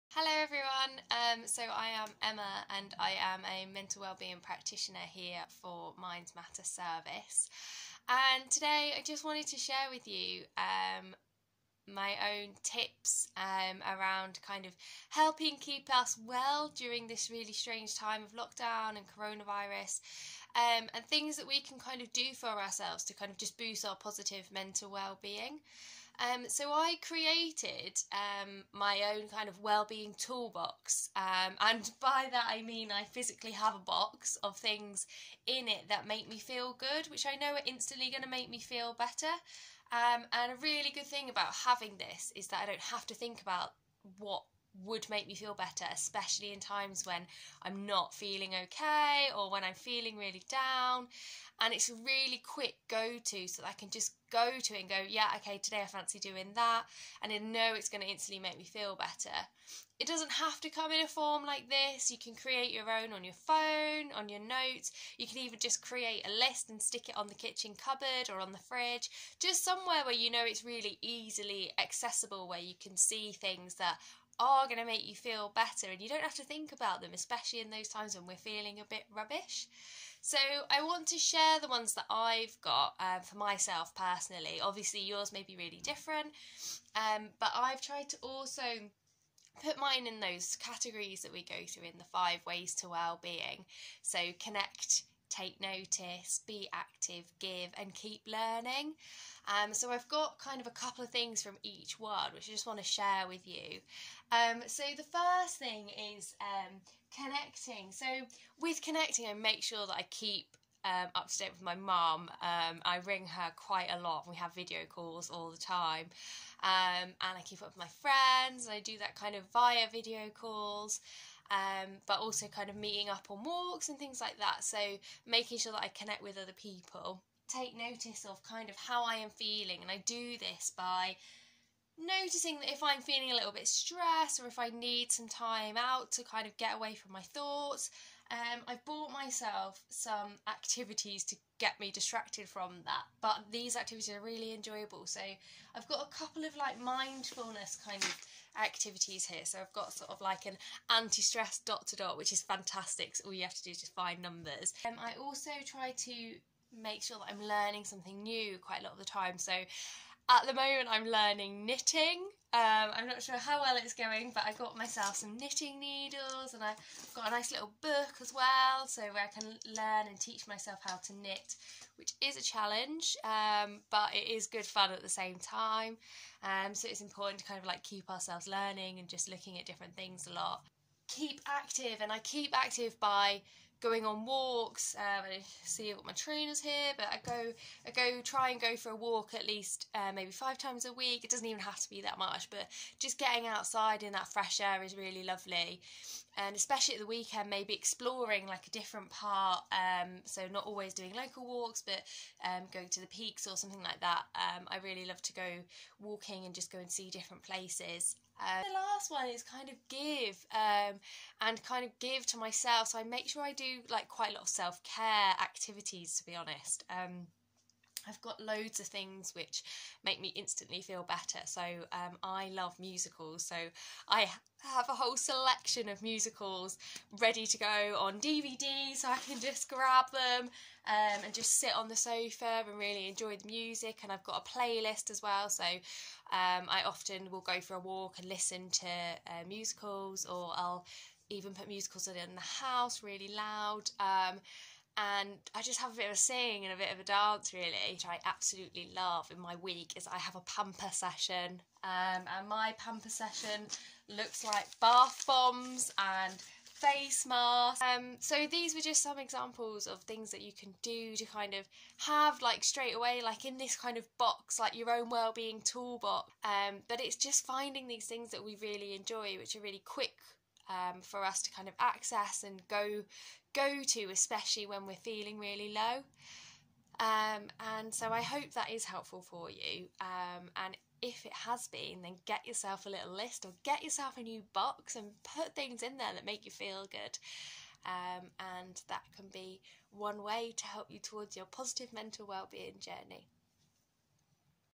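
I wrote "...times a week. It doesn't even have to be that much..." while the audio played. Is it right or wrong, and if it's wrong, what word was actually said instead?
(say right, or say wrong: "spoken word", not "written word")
right.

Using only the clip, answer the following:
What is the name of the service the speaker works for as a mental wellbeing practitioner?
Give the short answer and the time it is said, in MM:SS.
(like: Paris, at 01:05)
Minds Matter Service, at 00:05.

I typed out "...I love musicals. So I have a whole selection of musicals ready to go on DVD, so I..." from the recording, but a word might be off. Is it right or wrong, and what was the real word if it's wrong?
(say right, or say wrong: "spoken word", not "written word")
right.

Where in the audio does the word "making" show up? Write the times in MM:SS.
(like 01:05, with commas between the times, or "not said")
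02:05.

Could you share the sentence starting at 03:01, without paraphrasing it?
Keep active, and I keep active by going on walks.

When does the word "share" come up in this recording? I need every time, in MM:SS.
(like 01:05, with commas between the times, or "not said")
00:09, 01:21, 01:42.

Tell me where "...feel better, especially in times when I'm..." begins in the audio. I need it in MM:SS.
00:45.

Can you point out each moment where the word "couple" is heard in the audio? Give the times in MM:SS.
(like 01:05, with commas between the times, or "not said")
01:40, 02:26.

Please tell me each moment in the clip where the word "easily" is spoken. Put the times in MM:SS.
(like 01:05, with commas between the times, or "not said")
01:11.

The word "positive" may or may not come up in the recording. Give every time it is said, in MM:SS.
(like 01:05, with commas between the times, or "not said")
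00:23, 04:51.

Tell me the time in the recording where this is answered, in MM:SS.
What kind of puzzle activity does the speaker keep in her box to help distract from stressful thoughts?
02:30.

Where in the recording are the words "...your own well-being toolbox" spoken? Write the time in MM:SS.
04:24.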